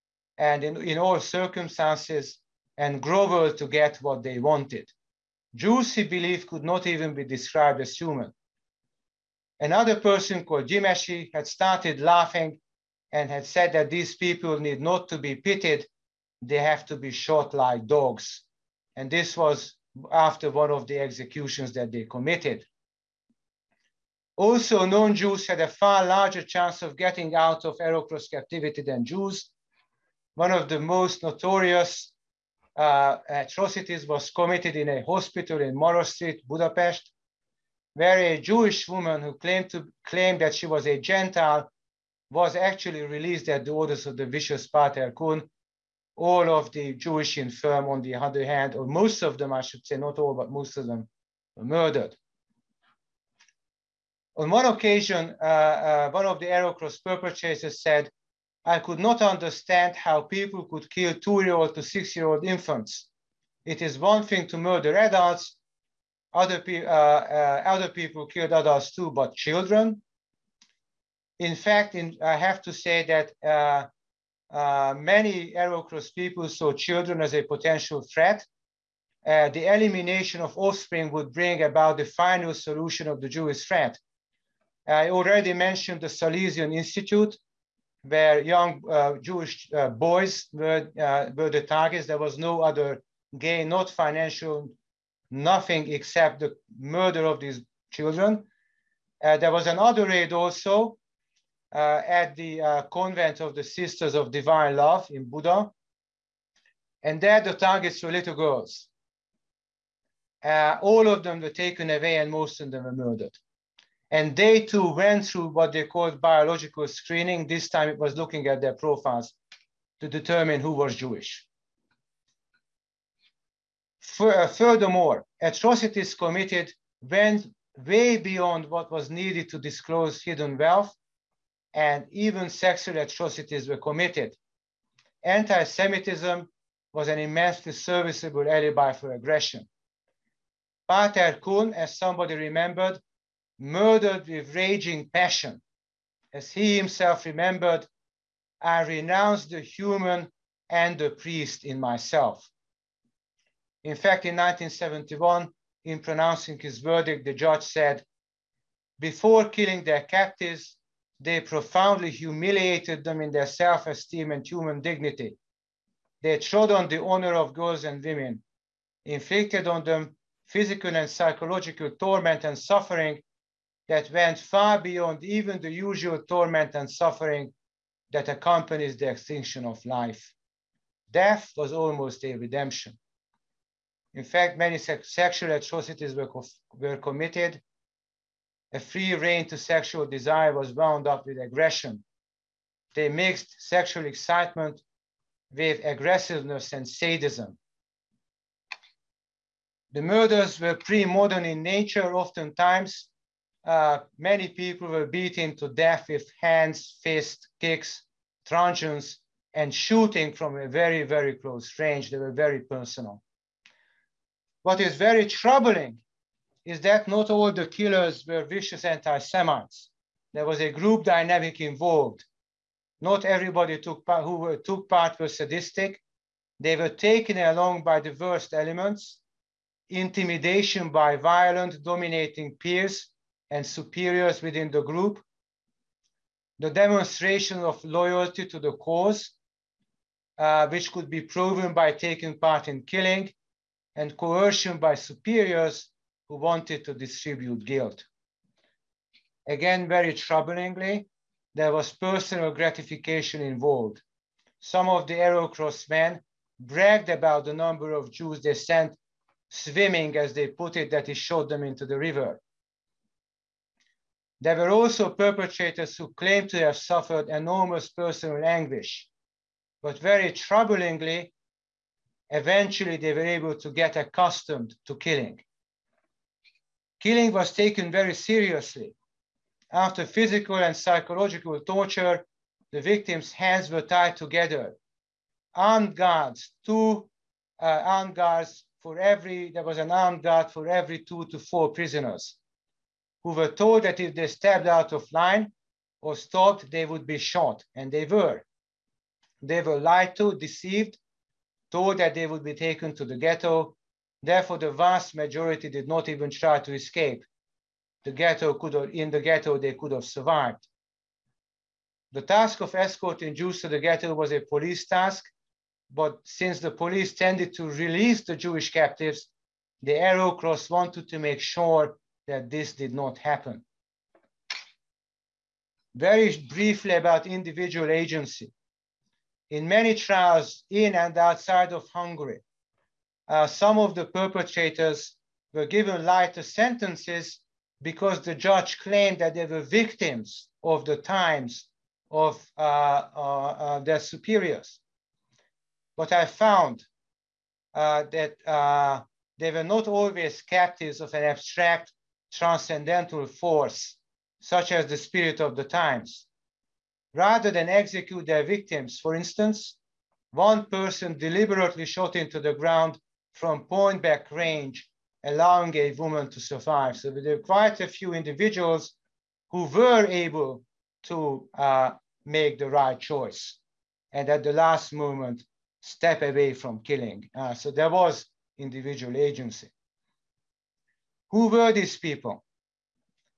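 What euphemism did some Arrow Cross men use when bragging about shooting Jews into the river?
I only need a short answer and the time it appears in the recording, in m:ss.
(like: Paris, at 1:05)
sent swimming, at 4:18.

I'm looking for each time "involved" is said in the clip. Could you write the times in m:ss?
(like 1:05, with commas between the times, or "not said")
3:41, 4:13.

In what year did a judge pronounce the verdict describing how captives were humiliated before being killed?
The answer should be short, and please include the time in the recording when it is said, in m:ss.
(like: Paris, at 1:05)
1971, at 2:34.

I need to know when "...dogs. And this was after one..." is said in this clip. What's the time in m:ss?
0:17.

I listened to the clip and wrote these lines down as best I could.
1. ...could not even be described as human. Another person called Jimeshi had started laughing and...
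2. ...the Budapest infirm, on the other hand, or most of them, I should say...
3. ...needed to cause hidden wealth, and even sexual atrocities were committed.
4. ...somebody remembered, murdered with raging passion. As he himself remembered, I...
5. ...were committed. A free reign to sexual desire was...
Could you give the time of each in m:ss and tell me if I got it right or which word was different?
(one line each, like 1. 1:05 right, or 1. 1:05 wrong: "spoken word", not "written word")
1. 0:06 right
2. 0:46 wrong: "Jewish", not "Budapest"
3. 2:09 wrong: "disclose", not "cause"
4. 2:21 right
5. 3:06 right.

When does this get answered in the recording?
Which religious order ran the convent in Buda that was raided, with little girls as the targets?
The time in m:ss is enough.
1:43.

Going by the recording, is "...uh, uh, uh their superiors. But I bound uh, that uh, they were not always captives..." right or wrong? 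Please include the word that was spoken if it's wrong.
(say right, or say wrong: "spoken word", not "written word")
wrong: "found", not "bound".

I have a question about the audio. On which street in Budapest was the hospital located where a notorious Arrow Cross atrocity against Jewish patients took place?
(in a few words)
Maros Street.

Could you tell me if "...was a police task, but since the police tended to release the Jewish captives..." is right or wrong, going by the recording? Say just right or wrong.
right.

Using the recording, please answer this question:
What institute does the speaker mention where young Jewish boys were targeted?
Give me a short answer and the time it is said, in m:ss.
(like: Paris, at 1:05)
Salesian Institute, at 1:26.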